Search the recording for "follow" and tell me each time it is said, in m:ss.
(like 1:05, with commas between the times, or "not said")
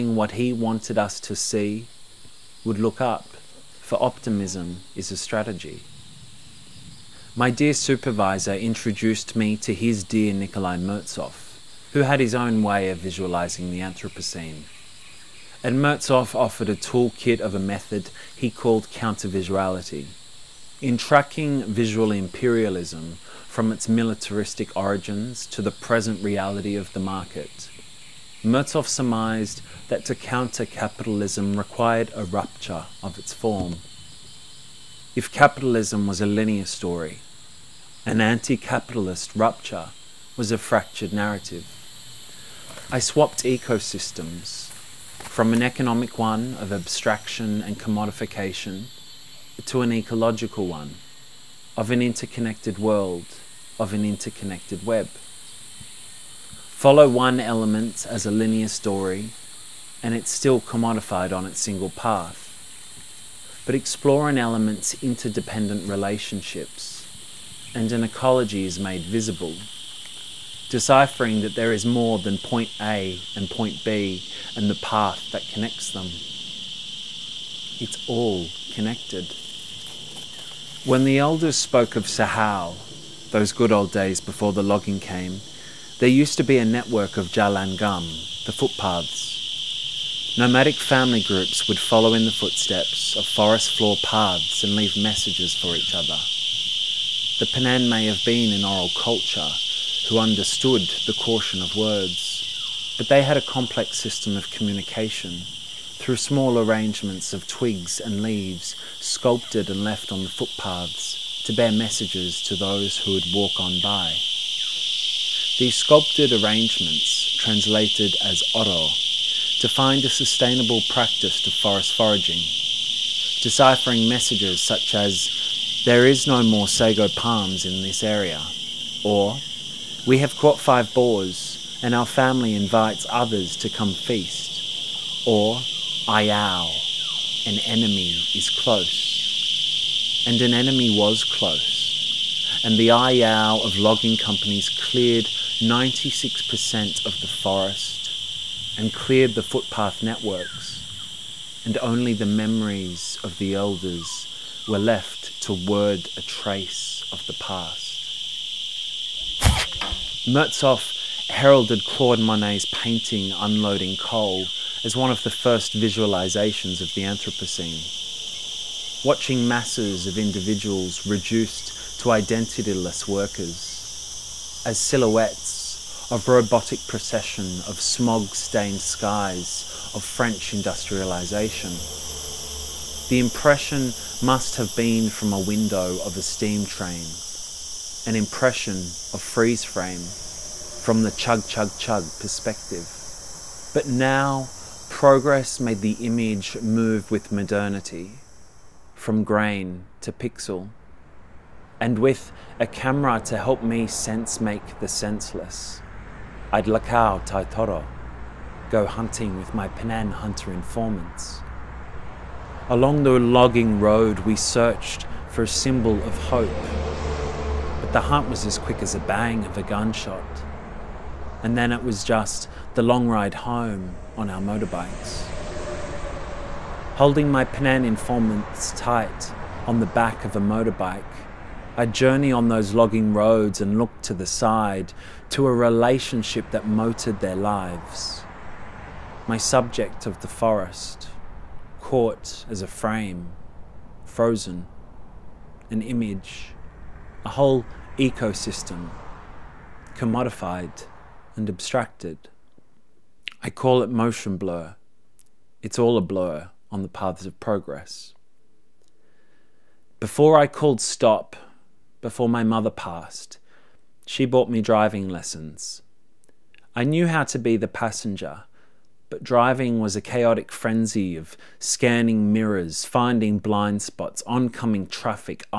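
0:56, 1:31.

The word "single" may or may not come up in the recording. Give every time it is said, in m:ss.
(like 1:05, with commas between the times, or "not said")
1:01.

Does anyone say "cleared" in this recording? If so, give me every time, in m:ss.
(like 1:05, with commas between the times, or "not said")
2:24, 2:28.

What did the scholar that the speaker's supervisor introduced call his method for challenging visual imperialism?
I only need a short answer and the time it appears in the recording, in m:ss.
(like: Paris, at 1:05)
countervisuality, at 0:18.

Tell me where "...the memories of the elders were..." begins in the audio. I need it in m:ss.
2:32.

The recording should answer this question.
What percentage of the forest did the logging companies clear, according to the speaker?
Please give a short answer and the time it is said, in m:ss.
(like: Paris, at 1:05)
96%, at 2:25.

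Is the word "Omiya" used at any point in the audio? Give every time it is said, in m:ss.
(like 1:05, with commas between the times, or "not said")
not said.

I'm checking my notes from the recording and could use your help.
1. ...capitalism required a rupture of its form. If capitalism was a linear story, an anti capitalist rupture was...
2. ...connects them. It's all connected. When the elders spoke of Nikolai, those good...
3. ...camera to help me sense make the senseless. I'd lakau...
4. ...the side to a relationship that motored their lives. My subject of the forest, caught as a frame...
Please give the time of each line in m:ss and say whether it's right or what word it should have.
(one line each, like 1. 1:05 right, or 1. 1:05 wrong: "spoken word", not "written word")
1. 0:30 right
2. 1:15 wrong: "Sahal", not "Nikolai"
3. 3:22 right
4. 3:54 right.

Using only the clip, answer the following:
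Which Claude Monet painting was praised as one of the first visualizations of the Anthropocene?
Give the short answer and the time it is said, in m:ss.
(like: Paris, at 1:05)
Unloading Coal, at 2:43.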